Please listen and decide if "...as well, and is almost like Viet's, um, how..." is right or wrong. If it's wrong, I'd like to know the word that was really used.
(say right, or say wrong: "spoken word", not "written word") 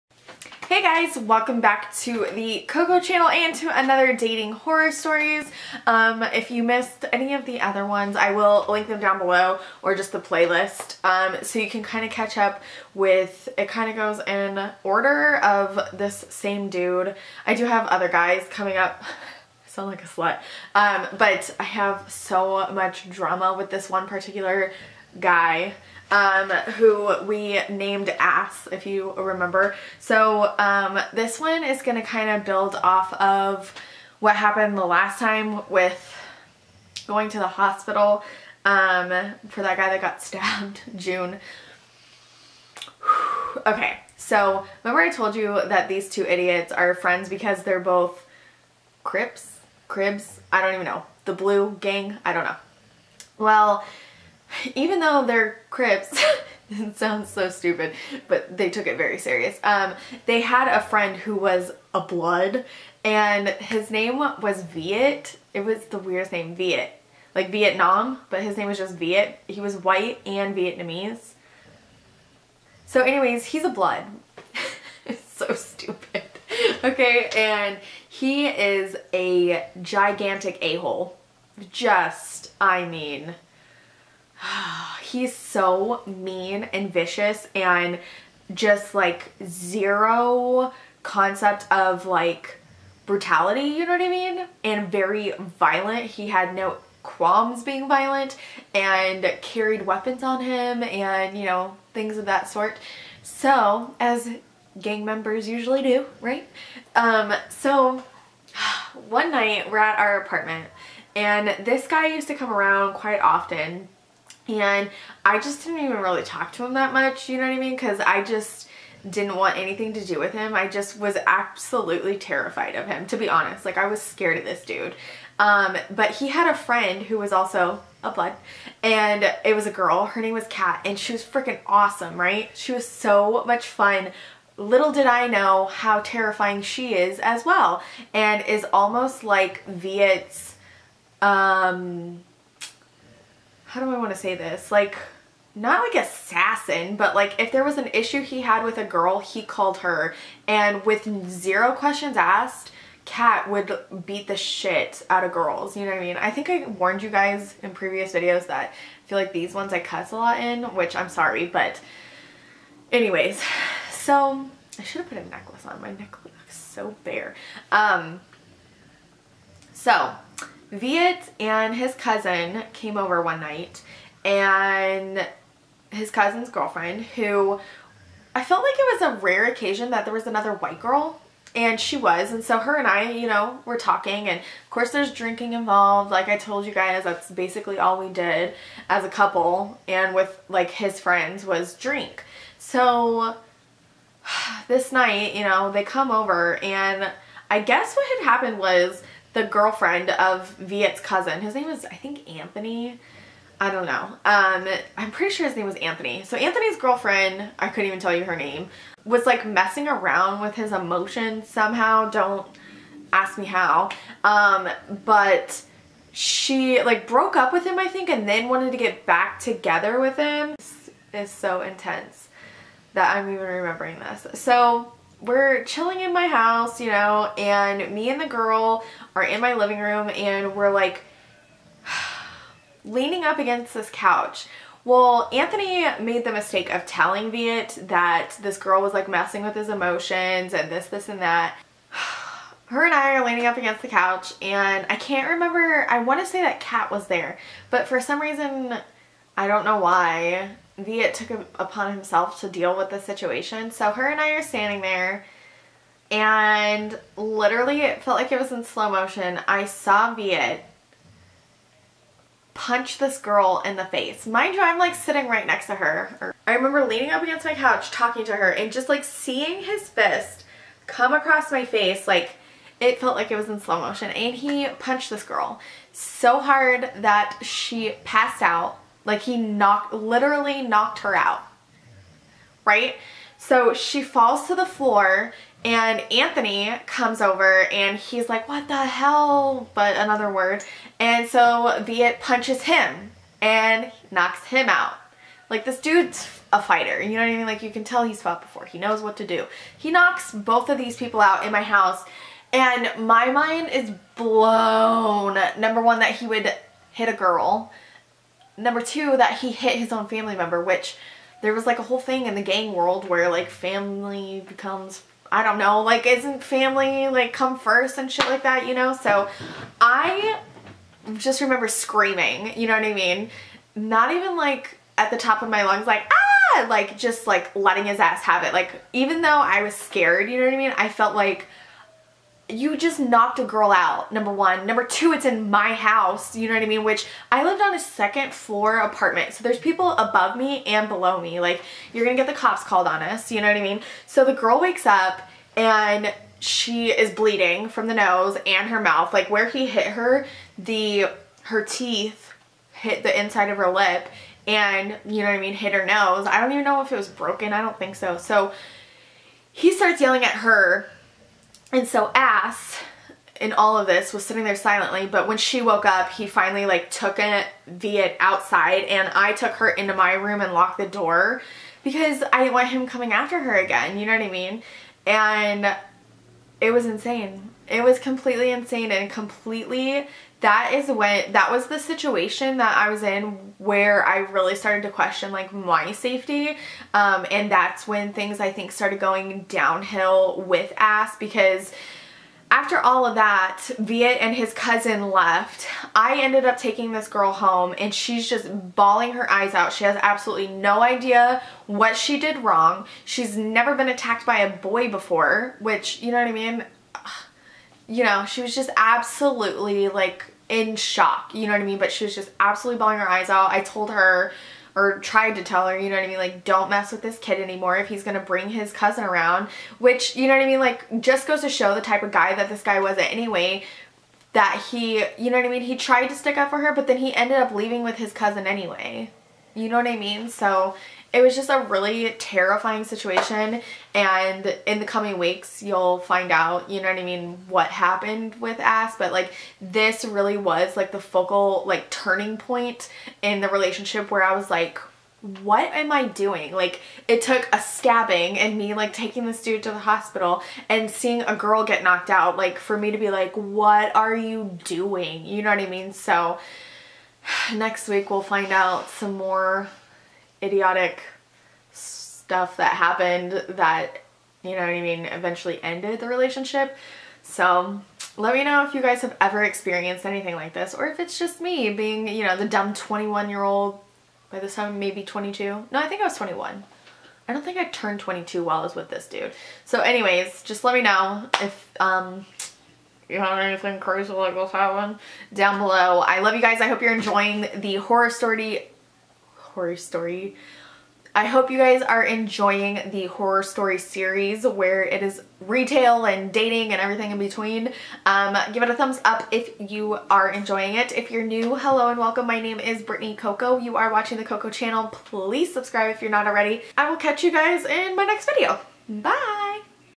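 right.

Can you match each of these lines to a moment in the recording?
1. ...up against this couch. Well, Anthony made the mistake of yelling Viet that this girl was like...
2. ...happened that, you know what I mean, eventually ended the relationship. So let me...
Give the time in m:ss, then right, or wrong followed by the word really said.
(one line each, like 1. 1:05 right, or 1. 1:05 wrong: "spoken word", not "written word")
1. 3:53 wrong: "telling", not "yelling"
2. 7:42 right.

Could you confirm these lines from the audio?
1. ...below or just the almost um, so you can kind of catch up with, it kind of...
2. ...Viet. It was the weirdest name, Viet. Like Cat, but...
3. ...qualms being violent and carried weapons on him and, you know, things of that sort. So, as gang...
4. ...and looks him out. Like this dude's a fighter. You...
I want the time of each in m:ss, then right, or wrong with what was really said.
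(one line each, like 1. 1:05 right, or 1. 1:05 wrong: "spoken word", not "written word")
1. 0:09 wrong: "playlist", not "almost"
2. 1:04 wrong: "Vietnam", not "Cat"
3. 1:37 right
4. 4:53 wrong: "knocks", not "looks".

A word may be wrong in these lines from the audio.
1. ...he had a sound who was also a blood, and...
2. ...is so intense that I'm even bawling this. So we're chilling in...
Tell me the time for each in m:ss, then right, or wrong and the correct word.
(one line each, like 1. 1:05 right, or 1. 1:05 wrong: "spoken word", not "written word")
1. 2:06 wrong: "friend", not "sound"
2. 3:41 wrong: "remembering", not "bawling".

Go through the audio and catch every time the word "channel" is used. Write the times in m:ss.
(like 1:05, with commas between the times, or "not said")
0:03, 8:24.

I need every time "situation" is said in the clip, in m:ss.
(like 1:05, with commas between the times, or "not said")
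4:12, 6:21, 7:12.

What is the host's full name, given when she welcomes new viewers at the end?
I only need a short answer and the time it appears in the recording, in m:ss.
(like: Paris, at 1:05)
Brittany Cocco, at 8:22.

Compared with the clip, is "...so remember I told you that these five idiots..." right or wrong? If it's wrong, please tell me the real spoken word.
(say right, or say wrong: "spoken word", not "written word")
wrong: "two", not "five".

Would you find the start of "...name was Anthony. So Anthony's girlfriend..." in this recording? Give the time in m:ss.
3:25.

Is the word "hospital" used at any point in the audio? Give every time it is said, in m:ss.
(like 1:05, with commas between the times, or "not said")
0:37, 7:29.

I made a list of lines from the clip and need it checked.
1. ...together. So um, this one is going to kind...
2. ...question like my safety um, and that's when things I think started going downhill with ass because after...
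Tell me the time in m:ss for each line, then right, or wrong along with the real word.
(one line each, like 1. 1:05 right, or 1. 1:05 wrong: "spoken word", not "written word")
1. 0:29 wrong: "remember", not "together"
2. 6:24 right.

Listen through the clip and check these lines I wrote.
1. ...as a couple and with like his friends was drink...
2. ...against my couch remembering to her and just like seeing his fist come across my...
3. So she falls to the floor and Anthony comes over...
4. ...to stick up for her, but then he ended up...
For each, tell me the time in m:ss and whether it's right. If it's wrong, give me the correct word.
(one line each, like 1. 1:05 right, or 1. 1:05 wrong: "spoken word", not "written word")
1. 3:08 right
2. 4:27 wrong: "talking", not "remembering"
3. 4:43 right
4. 7:06 right.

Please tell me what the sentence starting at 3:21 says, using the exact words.
His name is, I think, Anthony.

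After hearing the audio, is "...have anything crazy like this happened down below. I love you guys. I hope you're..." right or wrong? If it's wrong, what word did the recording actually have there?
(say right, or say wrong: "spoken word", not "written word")
right.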